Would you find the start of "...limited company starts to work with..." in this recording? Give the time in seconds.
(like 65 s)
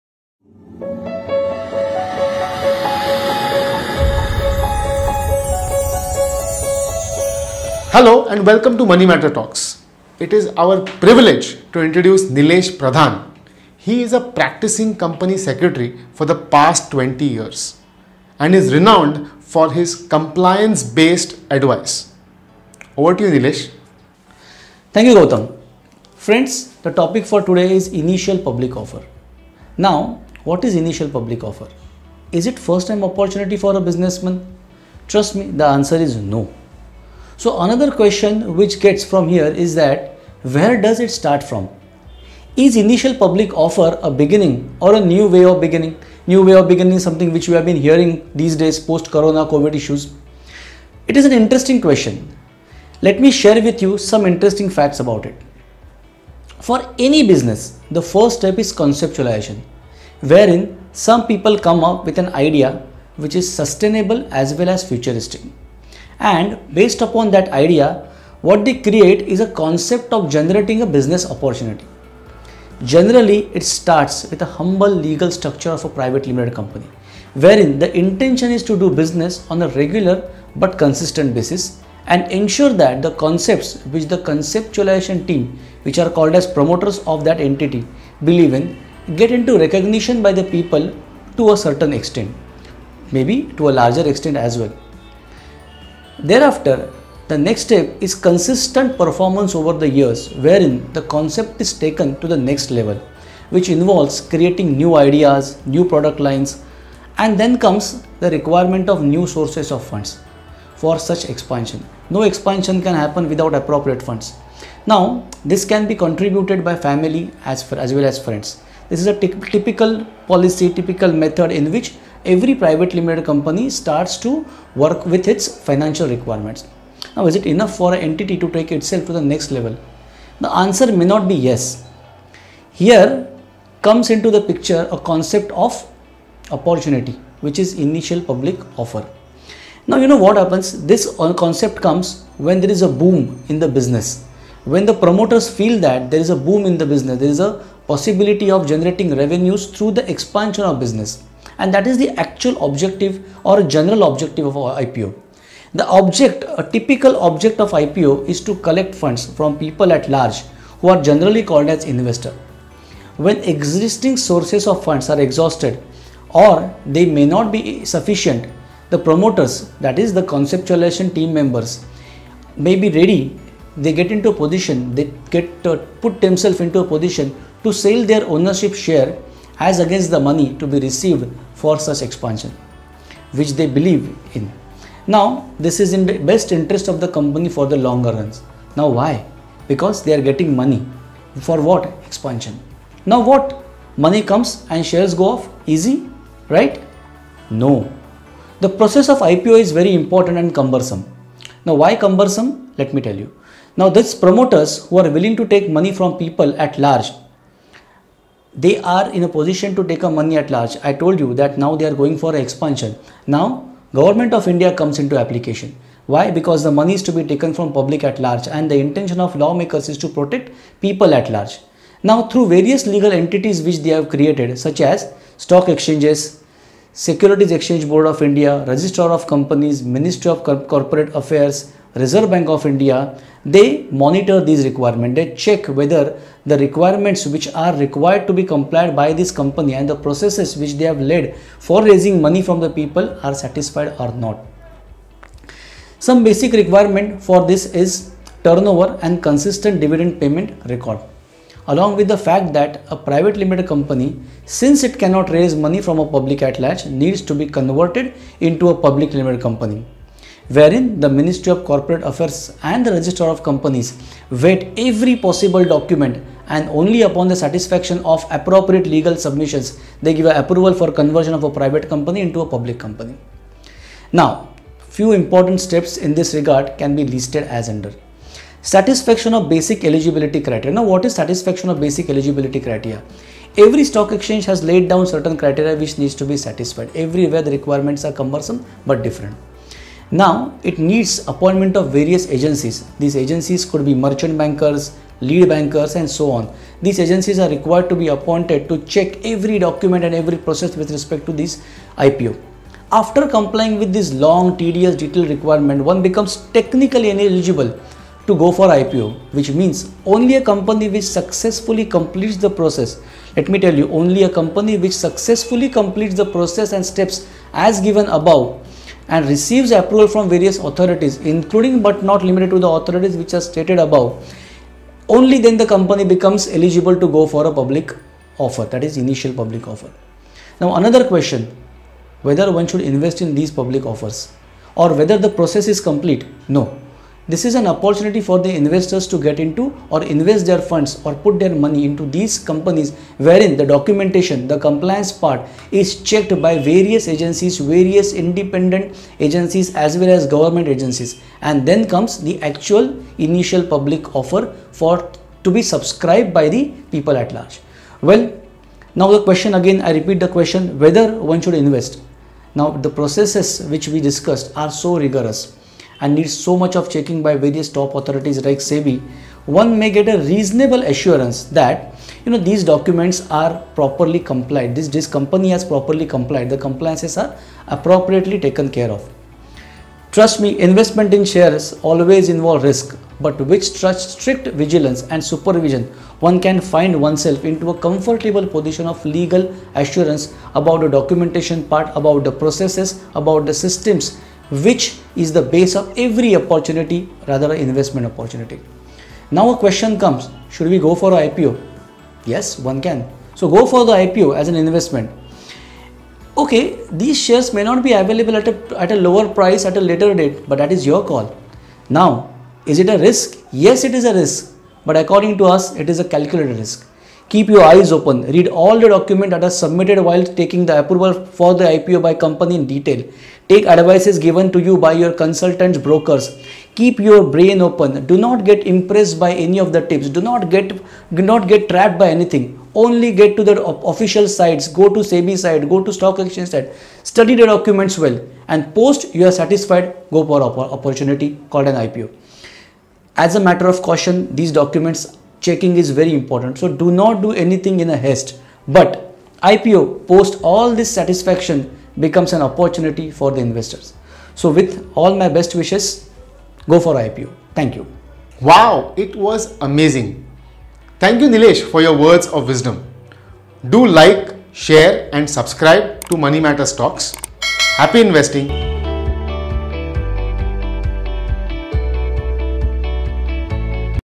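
122 s.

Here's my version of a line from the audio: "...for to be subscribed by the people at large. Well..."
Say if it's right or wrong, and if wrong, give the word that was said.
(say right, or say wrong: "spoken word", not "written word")
right.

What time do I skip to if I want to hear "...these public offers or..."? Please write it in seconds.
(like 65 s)
333 s.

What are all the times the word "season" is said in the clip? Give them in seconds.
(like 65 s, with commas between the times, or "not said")
not said.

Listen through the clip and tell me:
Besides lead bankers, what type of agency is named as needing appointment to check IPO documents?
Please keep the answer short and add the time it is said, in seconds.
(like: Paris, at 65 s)
Merchant bankers, at 293 s.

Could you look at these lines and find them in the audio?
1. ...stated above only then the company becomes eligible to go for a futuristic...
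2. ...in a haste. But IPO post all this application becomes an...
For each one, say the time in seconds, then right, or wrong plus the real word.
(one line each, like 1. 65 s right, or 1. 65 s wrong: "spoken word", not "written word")
1. 323 s wrong: "public", not "futuristic"
2. 447 s wrong: "satisfaction", not "application".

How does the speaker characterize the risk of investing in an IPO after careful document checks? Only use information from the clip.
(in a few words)
A calculated risk.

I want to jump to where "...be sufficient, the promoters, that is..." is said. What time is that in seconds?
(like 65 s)
167 s.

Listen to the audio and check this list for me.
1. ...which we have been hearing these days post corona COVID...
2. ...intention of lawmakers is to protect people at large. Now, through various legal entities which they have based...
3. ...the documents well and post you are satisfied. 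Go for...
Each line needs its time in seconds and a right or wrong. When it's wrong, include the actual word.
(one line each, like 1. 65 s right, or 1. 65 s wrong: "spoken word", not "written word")
1. 47 s right
2. 218 s wrong: "created", not "based"
3. 437 s right.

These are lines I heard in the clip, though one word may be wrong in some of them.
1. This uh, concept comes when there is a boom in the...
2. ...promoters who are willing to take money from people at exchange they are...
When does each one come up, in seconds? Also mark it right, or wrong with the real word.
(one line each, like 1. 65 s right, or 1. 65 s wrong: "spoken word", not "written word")
1. 140 s right
2. 204 s wrong: "large", not "exchange".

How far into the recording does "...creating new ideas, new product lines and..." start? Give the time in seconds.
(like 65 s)
104 s.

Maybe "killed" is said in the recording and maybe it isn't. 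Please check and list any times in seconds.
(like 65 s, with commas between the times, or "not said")
not said.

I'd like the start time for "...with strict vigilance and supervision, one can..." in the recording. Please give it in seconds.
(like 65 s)
383 s.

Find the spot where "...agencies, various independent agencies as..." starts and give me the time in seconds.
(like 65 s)
347 s.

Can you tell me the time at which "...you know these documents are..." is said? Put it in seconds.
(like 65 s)
372 s.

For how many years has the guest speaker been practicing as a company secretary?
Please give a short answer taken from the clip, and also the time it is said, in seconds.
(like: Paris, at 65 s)
20, at 16 s.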